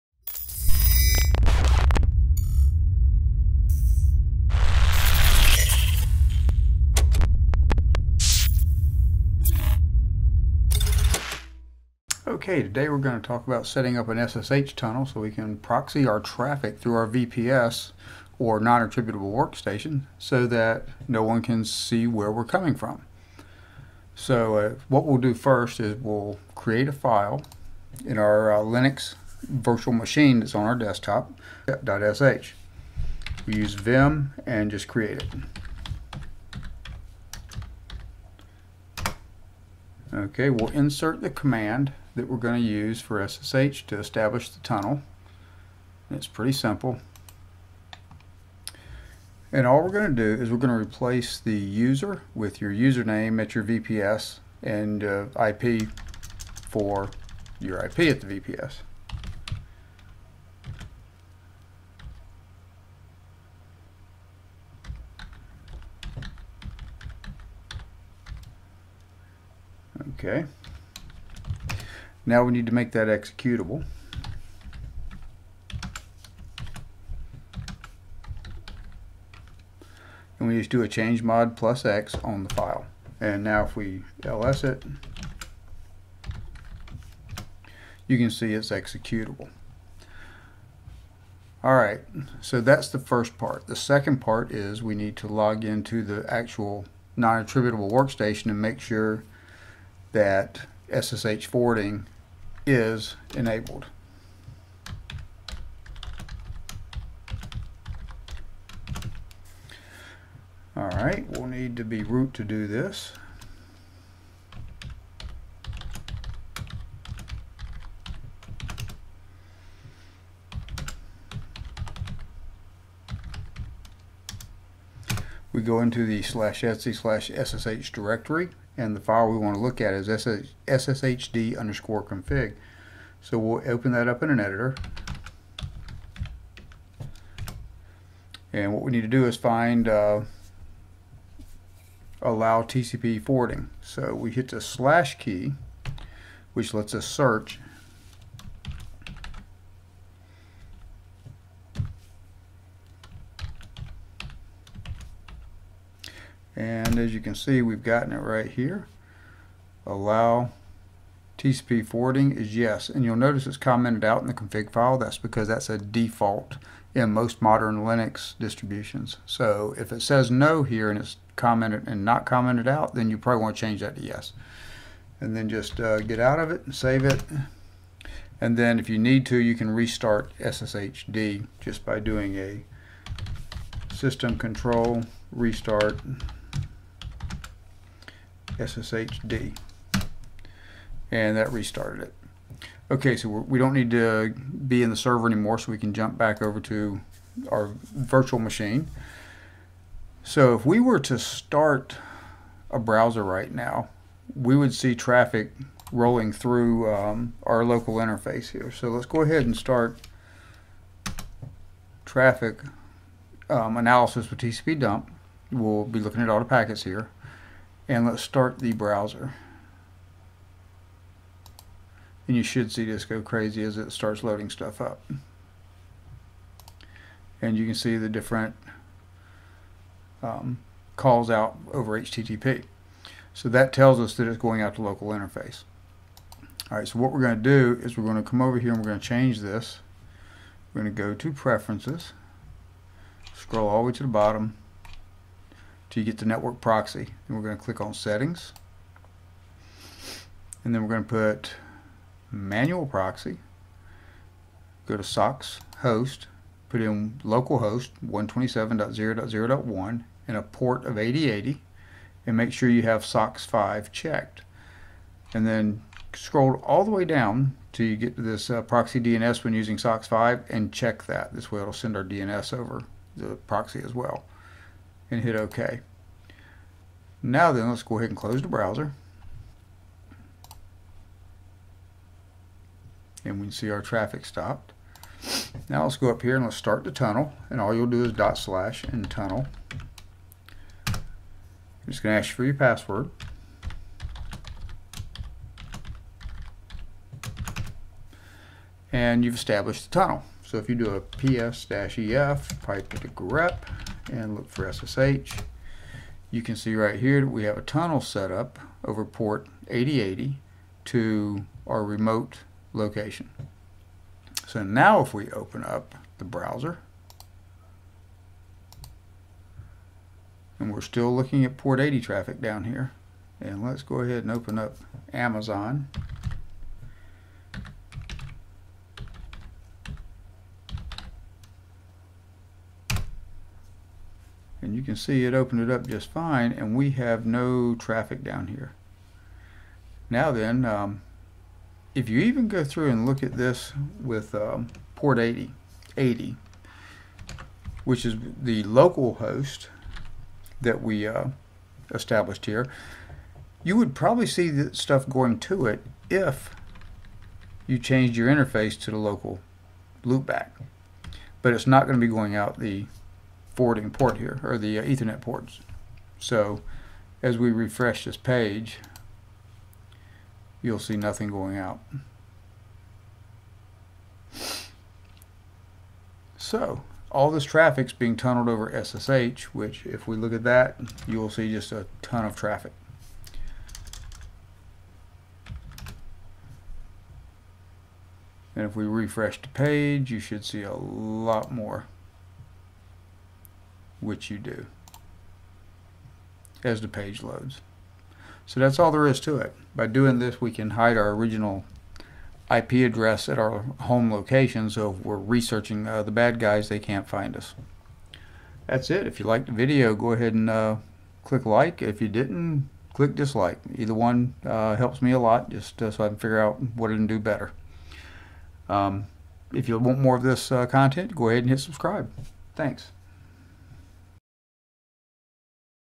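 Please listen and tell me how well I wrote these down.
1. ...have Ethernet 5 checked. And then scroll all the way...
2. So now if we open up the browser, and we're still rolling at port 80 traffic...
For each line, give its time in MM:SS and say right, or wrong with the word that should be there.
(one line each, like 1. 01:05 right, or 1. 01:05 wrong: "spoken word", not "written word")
1. 04:22 wrong: "SOCKS", not "Ethernet"
2. 05:14 wrong: "looking", not "rolling".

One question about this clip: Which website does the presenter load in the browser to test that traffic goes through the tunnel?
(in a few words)
Amazon.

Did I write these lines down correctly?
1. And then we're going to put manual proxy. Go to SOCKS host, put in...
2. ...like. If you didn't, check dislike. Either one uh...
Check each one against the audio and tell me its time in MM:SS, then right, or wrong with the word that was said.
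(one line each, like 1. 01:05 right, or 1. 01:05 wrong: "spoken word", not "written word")
1. 04:10 right
2. 06:51 wrong: "click", not "check".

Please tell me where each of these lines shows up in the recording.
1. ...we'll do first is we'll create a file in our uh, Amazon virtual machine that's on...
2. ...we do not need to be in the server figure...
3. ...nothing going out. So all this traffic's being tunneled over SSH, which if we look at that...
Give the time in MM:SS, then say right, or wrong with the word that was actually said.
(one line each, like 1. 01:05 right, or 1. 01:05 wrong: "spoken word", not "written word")
1. 00:25 wrong: "Linux", not "Amazon"
2. 03:13 wrong: "anymore", not "figure"
3. 06:10 right.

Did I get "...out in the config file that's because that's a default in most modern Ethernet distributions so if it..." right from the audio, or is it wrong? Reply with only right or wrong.
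wrong.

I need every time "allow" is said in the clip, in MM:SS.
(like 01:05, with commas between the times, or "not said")
02:22, 02:39.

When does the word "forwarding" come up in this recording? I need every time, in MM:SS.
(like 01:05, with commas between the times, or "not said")
01:41, 02:23, 02:41, 06:03.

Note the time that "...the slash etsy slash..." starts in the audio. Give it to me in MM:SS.
02:06.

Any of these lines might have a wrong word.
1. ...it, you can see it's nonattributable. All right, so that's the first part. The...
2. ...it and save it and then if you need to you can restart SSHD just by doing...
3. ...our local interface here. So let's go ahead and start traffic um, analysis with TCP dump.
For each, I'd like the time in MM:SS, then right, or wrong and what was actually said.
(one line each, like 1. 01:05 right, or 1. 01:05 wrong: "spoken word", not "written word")
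1. 01:24 wrong: "executable", not "nonattributable"
2. 02:56 right
3. 03:27 right.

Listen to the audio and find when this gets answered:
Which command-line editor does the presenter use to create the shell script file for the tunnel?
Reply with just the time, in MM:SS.
00:33.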